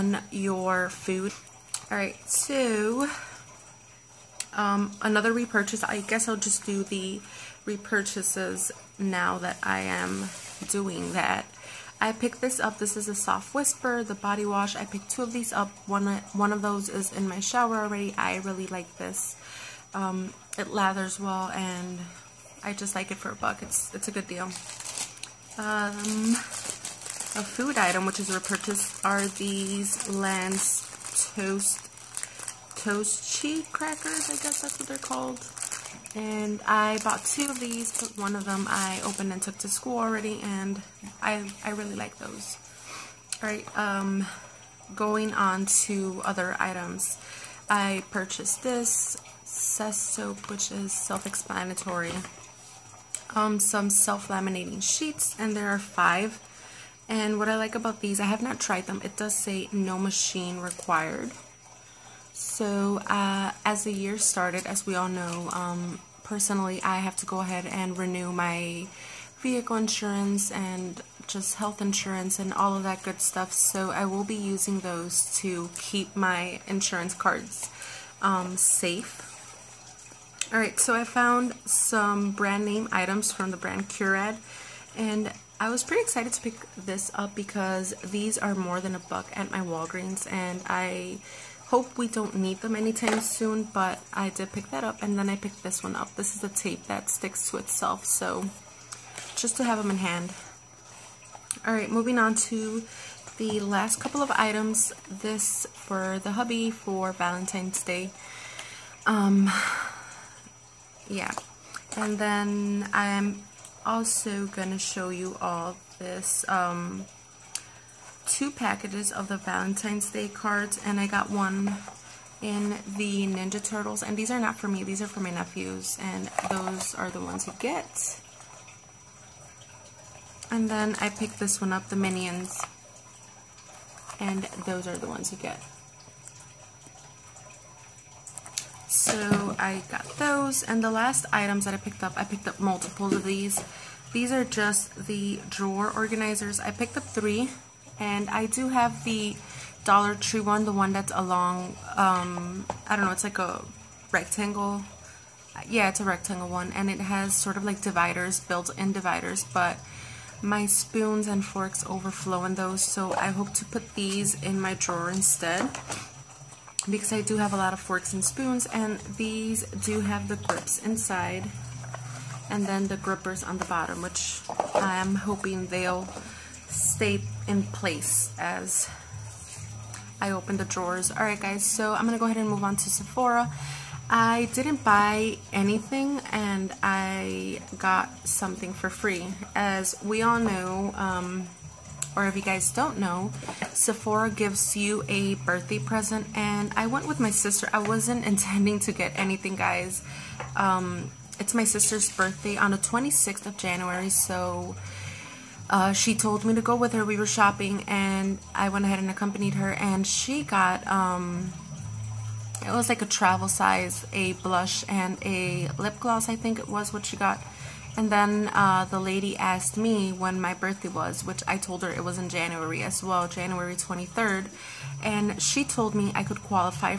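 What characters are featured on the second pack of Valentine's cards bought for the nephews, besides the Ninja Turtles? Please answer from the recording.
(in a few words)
Minions.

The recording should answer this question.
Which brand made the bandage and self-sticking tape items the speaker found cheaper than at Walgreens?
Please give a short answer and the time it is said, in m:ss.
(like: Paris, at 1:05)
Curad, at 1:23.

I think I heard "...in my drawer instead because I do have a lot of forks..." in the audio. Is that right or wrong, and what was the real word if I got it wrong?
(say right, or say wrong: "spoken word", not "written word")
right.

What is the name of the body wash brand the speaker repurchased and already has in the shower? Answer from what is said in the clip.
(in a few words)
Soft Whisper.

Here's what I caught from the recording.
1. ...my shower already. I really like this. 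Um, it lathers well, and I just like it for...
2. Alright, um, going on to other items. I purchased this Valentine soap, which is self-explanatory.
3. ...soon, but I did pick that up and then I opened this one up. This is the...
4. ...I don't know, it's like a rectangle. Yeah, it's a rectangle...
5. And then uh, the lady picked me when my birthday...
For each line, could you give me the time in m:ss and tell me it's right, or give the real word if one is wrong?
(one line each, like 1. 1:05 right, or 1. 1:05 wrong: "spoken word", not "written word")
1. 0:17 right
2. 0:43 wrong: "Cess", not "Valentine"
3. 1:33 wrong: "picked", not "opened"
4. 2:32 right
5. 3:37 wrong: "asked", not "picked".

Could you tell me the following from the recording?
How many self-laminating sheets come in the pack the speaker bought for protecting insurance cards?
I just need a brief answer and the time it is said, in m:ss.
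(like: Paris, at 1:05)
5, at 0:55.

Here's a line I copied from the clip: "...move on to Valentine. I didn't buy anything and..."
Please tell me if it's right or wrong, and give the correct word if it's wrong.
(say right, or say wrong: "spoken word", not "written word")
wrong: "Sephora", not "Valentine".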